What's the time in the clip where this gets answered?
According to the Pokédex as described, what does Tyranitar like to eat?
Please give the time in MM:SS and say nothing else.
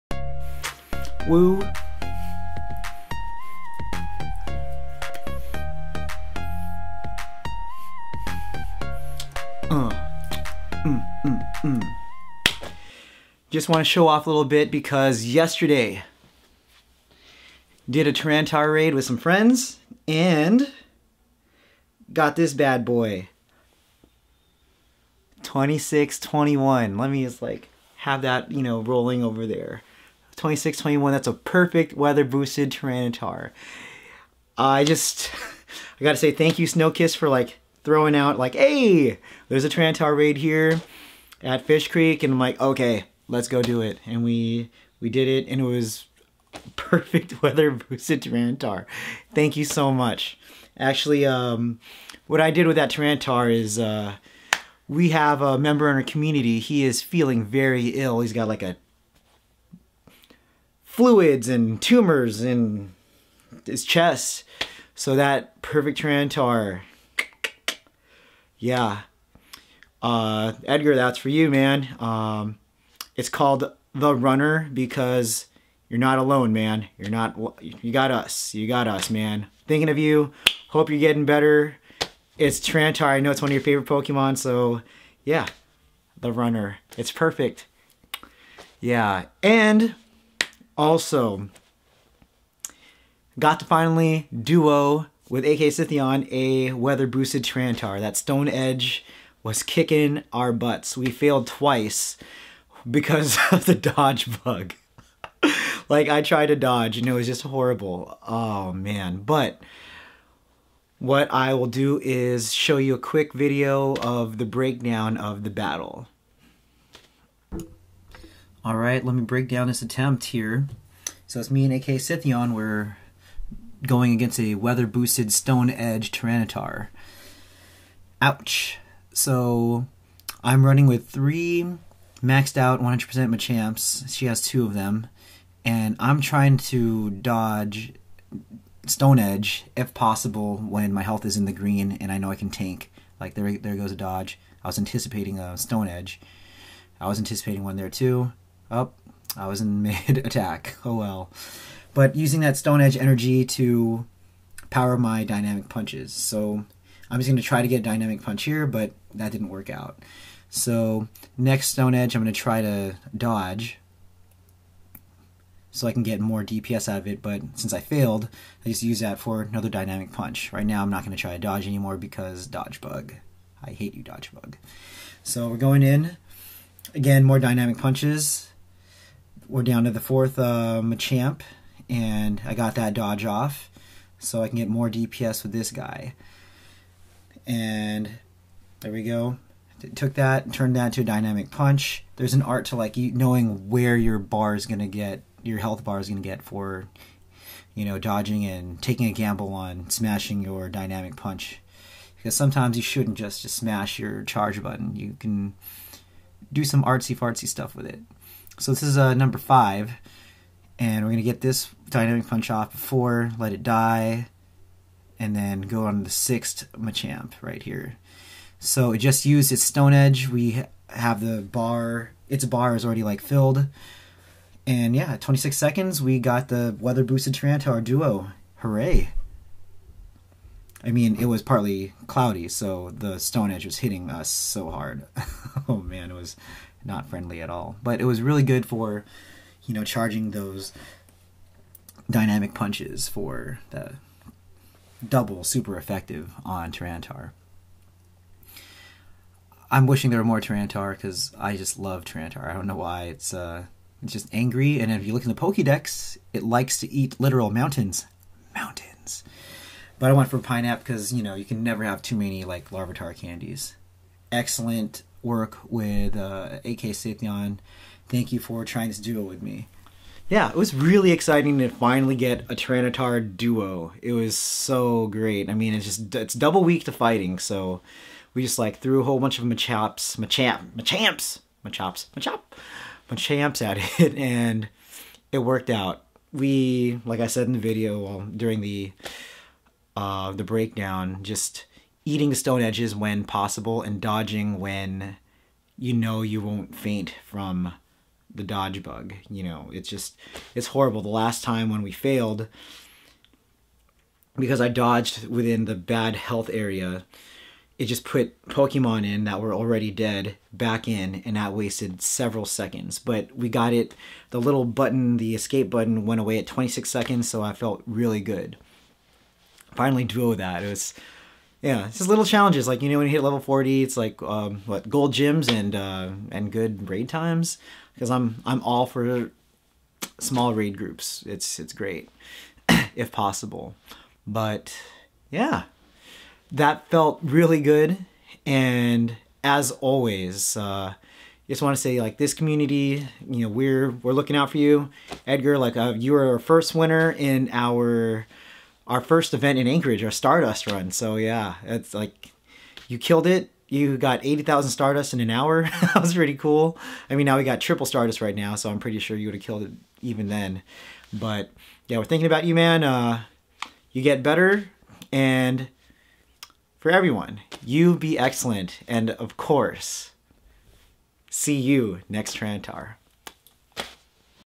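04:17.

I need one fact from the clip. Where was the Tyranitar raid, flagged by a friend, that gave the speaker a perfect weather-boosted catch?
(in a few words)
Fish Creek.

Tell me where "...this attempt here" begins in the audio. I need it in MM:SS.
01:59.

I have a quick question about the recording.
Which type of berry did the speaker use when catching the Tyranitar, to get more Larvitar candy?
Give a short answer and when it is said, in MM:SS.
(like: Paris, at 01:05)
pineapple, at 04:20.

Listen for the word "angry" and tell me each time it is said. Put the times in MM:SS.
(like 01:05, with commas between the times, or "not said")
04:14.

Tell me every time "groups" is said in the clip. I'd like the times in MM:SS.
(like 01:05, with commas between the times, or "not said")
05:30.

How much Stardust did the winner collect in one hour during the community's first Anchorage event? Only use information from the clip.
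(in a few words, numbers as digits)
80,000.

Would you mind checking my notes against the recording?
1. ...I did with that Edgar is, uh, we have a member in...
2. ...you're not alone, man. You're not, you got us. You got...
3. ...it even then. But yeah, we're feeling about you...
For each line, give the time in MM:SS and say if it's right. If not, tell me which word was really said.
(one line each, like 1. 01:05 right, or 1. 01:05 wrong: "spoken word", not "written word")
1. 00:52 wrong: "Tyranitar", not "Edgar"
2. 01:15 right
3. 05:59 wrong: "thinking", not "feeling".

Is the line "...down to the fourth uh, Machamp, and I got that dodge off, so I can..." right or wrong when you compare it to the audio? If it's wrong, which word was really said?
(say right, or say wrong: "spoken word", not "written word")
right.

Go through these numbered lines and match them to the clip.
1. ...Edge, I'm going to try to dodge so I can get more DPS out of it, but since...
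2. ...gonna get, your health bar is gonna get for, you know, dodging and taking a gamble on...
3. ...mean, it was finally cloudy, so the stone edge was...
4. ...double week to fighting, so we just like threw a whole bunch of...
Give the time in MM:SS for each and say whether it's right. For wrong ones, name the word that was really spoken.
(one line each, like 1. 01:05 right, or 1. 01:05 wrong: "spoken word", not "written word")
1. 02:41 right
2. 03:14 right
3. 03:50 wrong: "partly", not "finally"
4. 04:36 right.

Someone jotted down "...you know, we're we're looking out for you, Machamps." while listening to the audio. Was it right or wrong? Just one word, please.
wrong.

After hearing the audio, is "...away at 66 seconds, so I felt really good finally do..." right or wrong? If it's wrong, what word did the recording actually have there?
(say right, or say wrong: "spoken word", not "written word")
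wrong: "26", not "66".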